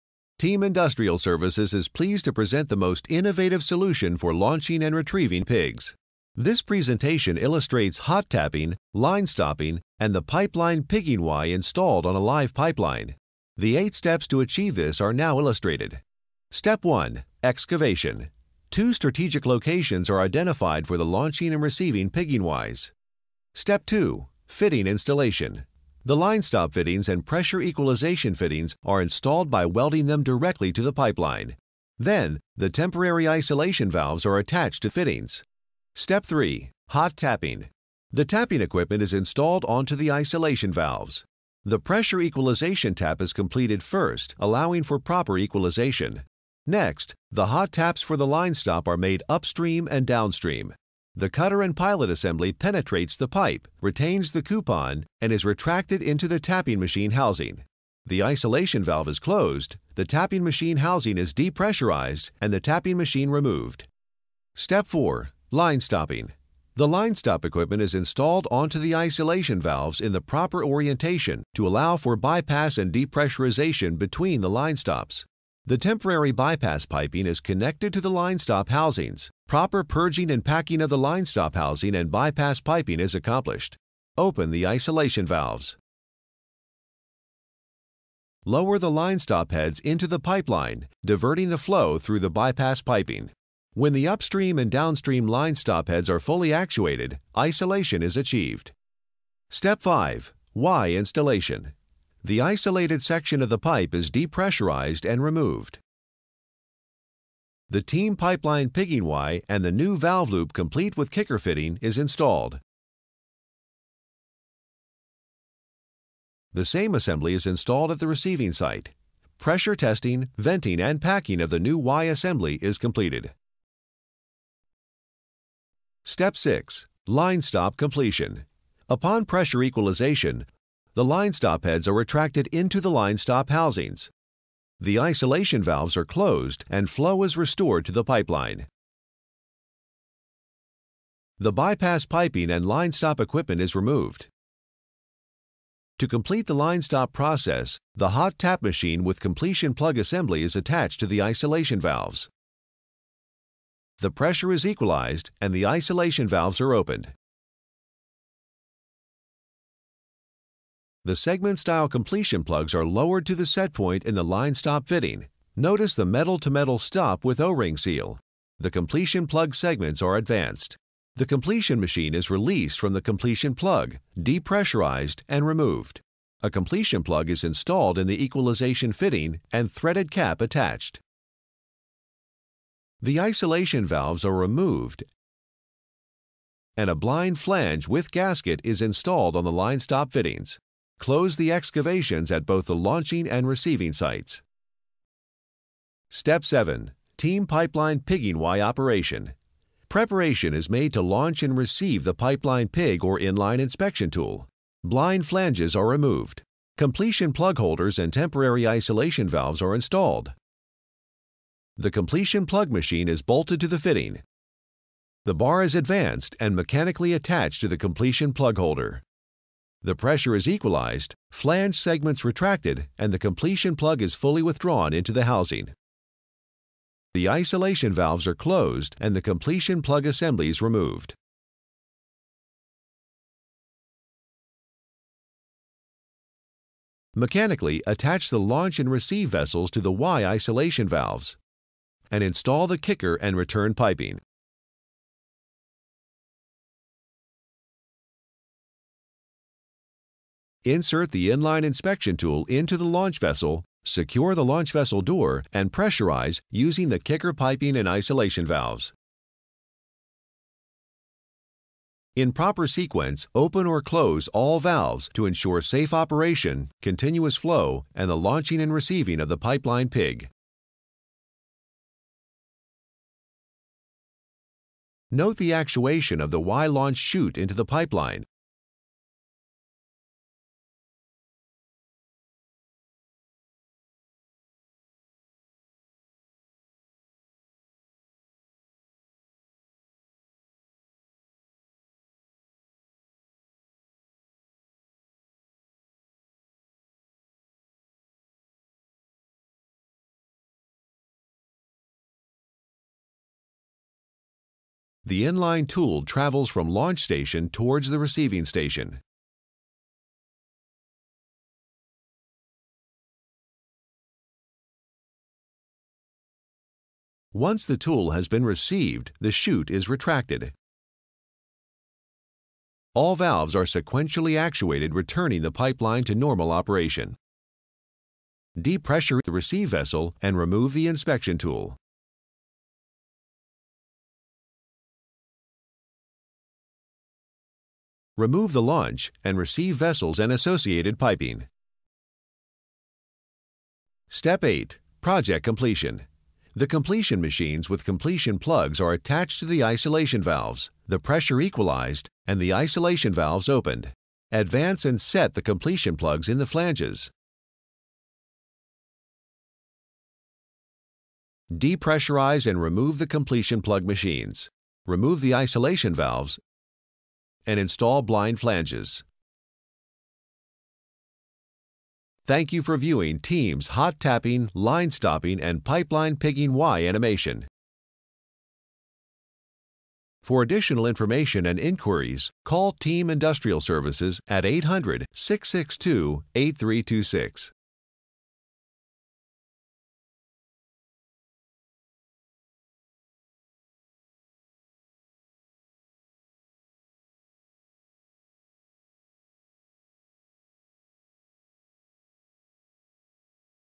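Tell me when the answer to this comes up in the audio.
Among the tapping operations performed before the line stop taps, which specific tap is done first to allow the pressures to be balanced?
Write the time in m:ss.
0:41.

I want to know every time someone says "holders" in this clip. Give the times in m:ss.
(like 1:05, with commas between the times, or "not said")
3:27, 3:38.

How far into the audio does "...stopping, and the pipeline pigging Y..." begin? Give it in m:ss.
0:09.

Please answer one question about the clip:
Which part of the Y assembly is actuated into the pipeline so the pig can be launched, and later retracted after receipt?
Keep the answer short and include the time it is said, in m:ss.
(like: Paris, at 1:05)
launch chute, at 4:36.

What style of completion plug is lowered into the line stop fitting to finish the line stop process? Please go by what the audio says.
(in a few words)
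segment style.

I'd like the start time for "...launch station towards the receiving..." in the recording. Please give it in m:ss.
5:06.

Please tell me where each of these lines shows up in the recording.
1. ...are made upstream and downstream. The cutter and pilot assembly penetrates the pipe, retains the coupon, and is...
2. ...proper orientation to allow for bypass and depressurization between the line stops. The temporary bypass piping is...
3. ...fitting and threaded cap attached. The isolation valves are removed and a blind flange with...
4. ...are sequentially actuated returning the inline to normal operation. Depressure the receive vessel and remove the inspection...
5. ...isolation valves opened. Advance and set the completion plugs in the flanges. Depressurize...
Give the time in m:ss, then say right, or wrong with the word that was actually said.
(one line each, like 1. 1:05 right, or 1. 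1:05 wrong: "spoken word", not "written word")
1. 0:48 right
2. 1:10 right
3. 2:58 right
4. 5:23 wrong: "pipeline", not "inline"
5. 5:52 right.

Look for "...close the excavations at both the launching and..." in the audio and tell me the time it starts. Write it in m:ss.
3:11.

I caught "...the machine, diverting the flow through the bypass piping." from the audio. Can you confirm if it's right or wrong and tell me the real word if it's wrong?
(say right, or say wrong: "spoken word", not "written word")
wrong: "pipeline", not "machine".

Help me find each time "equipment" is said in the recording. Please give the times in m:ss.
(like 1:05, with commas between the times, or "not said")
0:38, 1:07, 2:23.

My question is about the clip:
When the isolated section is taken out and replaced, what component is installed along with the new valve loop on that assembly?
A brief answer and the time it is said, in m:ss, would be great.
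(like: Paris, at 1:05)
kicker fitting, at 1:51.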